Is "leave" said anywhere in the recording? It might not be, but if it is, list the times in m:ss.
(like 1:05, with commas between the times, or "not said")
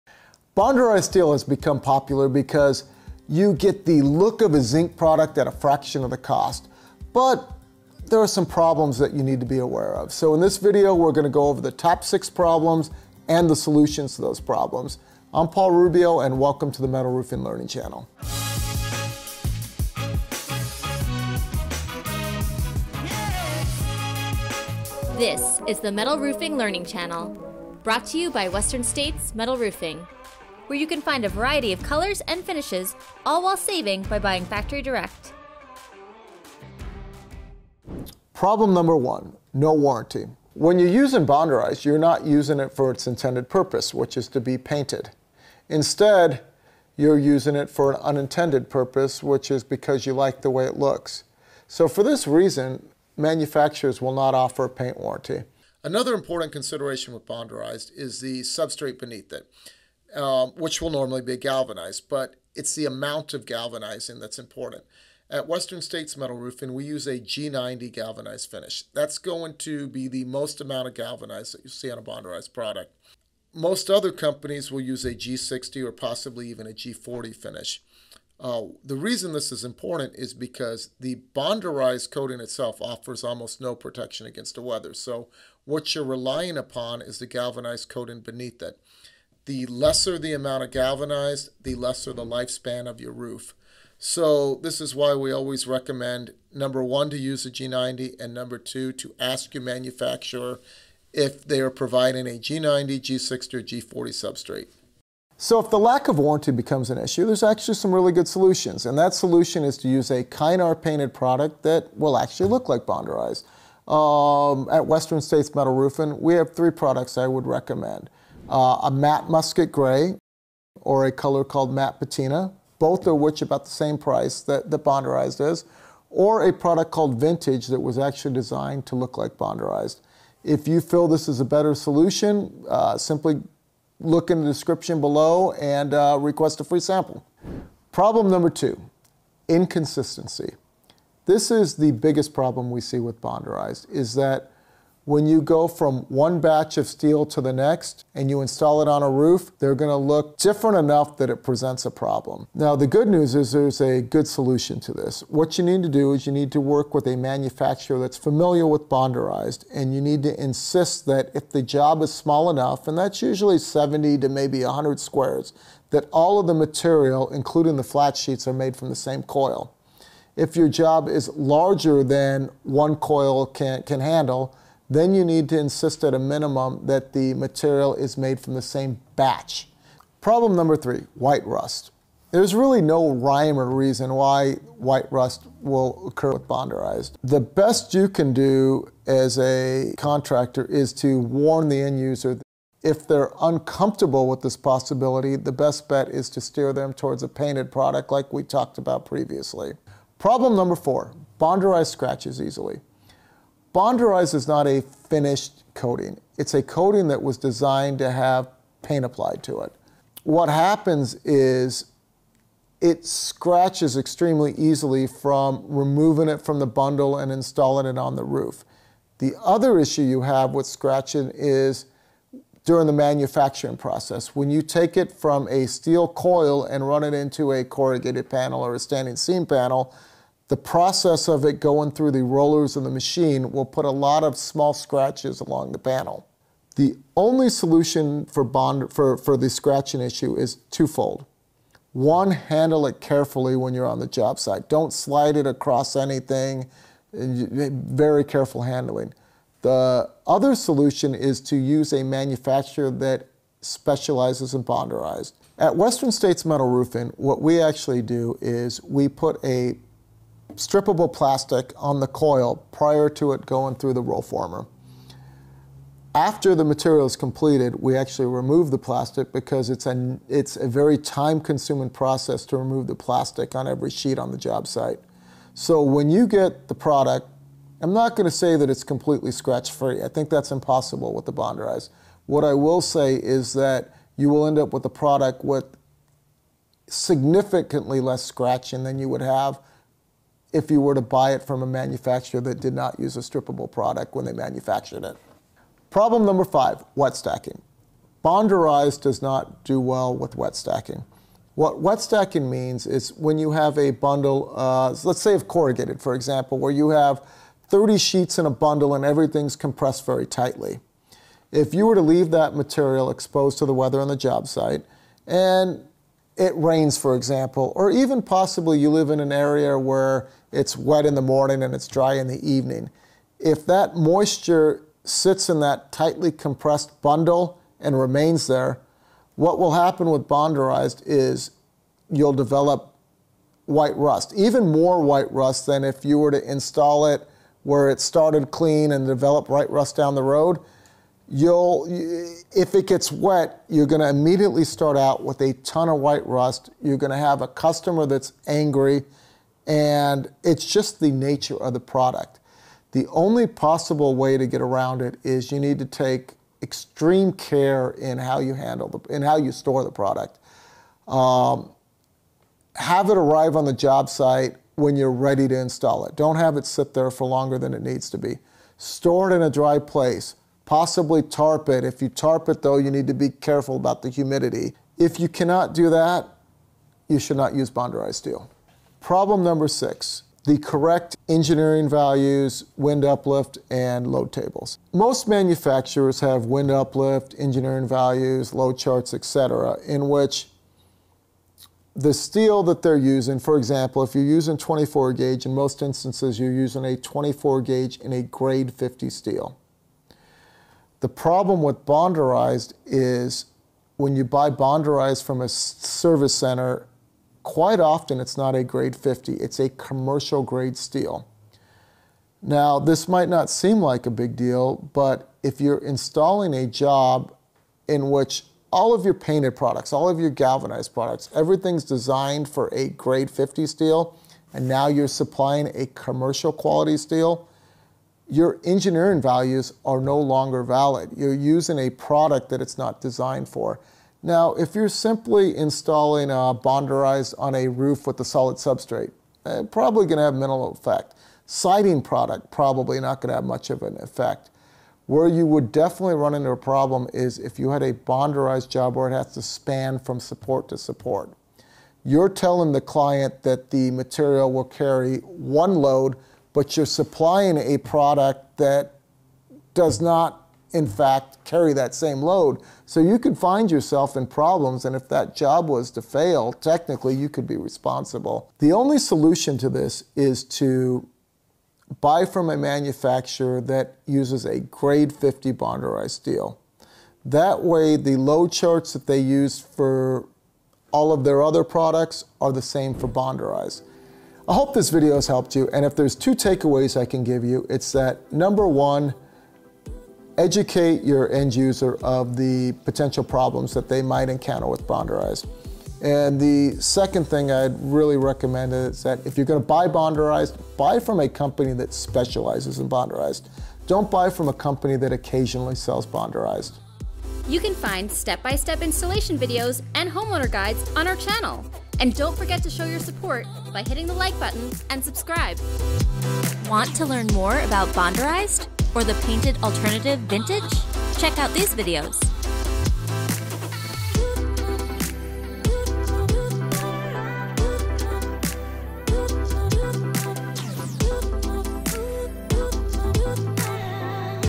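5:12.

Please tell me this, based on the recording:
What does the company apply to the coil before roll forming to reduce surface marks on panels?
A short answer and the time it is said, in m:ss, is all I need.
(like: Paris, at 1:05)
strippable plastic, at 4:20.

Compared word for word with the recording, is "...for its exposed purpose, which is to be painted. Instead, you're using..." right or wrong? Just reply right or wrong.
wrong.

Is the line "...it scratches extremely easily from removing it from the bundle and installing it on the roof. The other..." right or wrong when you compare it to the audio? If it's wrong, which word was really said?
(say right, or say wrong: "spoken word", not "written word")
right.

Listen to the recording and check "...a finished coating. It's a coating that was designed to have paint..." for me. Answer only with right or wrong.
right.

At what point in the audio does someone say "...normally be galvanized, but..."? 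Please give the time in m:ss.
1:00.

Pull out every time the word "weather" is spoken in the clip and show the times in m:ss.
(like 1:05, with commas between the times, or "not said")
1:24, 5:13.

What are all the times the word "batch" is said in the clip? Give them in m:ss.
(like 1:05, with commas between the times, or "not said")
2:26, 2:59.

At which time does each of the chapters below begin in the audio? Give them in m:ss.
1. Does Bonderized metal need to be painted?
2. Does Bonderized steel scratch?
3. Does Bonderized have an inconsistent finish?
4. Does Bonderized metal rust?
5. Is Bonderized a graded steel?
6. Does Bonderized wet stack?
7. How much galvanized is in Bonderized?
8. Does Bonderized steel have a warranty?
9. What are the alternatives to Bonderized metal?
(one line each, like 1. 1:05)
1. 0:40
2. 3:21
3. 2:18
4. 3:01
5. 6:19
6. 4:56
7. 1:00
8. 0:50
9. 1:53.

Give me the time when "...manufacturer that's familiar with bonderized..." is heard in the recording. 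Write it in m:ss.
2:37.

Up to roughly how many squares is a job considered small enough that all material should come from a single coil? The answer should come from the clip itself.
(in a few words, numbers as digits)
100.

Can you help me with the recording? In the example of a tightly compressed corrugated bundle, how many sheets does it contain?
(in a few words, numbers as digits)
30.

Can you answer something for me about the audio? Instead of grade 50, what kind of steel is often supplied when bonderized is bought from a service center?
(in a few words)
commercial grade steel.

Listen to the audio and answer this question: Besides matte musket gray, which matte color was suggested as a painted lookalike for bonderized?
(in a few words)
matte patina.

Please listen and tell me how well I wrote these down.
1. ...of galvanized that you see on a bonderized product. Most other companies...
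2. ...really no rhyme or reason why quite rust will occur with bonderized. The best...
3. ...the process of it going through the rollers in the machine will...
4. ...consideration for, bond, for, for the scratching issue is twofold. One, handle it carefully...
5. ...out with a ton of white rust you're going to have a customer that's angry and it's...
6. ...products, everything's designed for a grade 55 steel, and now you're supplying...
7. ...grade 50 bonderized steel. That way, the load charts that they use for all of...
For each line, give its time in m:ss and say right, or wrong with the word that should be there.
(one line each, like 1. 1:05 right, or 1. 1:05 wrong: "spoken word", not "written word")
1. 1:10 right
2. 3:02 wrong: "white", not "quite"
3. 3:50 right
4. 3:57 wrong: "solution", not "consideration"
5. 5:44 right
6. 7:00 wrong: "50", not "55"
7. 7:54 right.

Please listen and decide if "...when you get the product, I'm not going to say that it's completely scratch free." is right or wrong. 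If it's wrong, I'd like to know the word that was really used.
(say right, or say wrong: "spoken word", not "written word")
right.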